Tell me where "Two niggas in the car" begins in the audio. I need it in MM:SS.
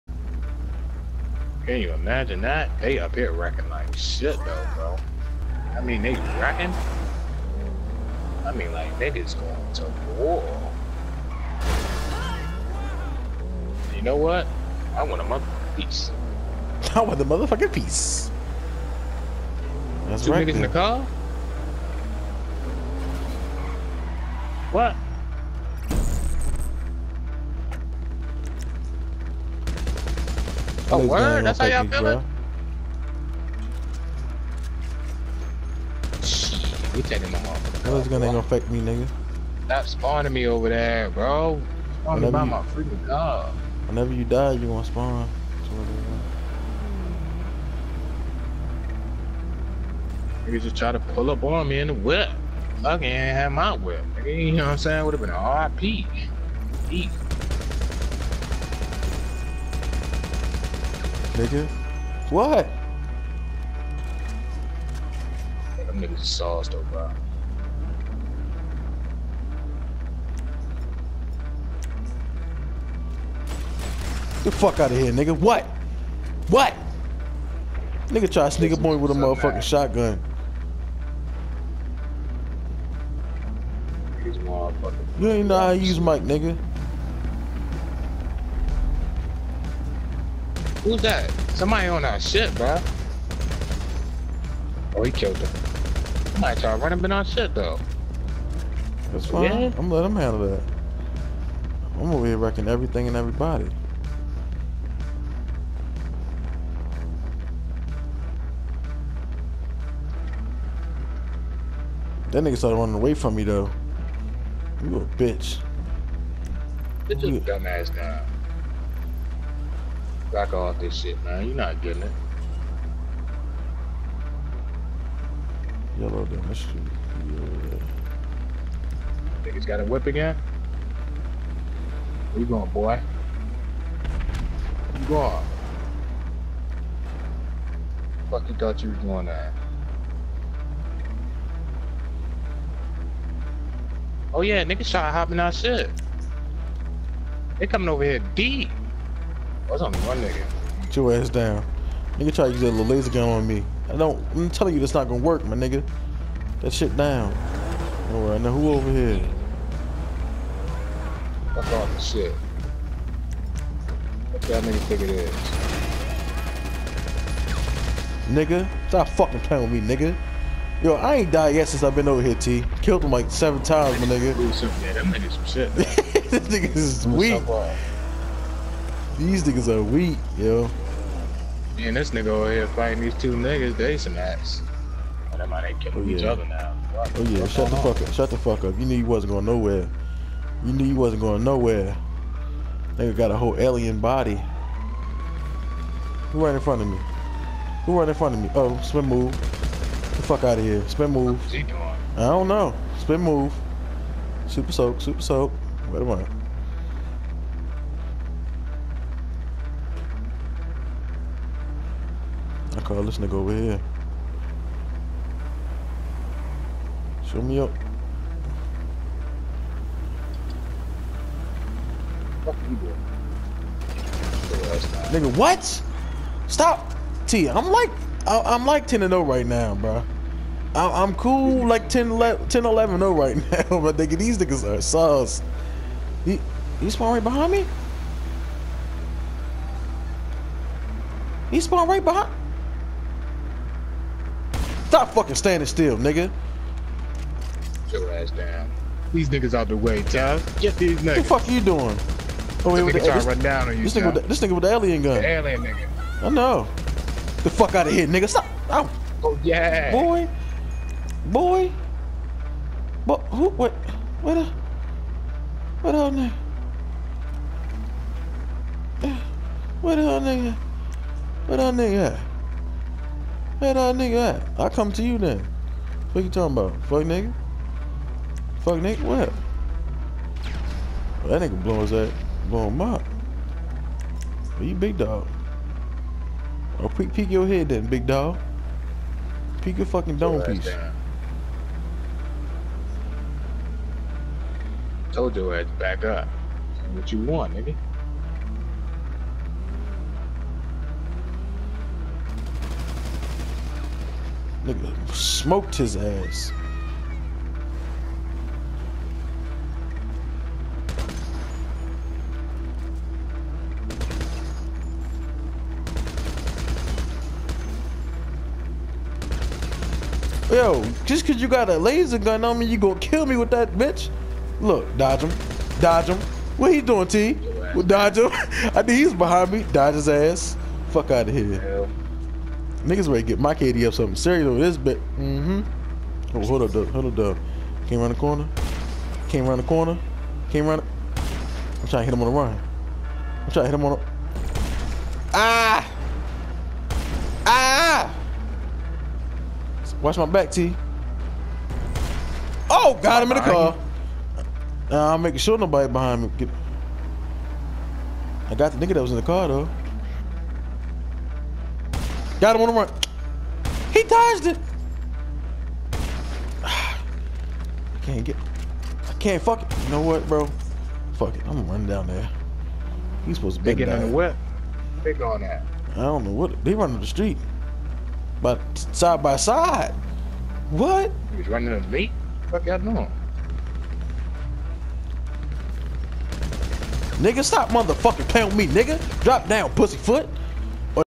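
00:20.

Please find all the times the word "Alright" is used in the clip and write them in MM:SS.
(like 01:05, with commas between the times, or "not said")
02:38.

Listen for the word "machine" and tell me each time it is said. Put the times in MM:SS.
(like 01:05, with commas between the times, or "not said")
not said.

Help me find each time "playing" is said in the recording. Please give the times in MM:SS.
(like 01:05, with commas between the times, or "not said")
02:49, 06:28.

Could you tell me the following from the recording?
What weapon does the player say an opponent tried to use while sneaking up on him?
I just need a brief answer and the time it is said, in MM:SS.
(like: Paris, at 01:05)
shotgun, at 01:19.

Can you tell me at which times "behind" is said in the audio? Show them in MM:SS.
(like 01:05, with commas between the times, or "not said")
03:57, 04:02, 05:29, 05:55.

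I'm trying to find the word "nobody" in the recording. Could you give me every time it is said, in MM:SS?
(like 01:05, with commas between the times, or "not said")
05:55.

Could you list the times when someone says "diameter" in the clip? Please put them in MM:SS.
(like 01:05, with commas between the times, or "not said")
not said.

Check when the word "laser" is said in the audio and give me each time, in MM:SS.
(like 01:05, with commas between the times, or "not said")
02:32, 05:21.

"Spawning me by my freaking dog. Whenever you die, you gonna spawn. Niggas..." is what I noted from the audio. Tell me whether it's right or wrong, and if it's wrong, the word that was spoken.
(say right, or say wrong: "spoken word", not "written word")
right.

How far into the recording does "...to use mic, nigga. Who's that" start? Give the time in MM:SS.
01:25.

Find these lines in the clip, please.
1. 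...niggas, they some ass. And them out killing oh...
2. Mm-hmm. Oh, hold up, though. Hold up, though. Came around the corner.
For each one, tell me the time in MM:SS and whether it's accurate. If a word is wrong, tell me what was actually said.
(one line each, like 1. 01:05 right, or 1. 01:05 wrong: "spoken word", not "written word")
1. 03:03 right
2. 05:35 right.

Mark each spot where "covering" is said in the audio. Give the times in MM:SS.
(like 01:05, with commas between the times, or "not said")
not said.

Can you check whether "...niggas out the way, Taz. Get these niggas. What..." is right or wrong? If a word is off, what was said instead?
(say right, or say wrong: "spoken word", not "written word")
right.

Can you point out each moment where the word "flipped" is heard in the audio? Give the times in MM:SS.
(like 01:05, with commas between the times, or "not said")
not said.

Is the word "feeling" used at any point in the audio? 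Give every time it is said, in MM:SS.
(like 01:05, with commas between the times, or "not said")
00:31.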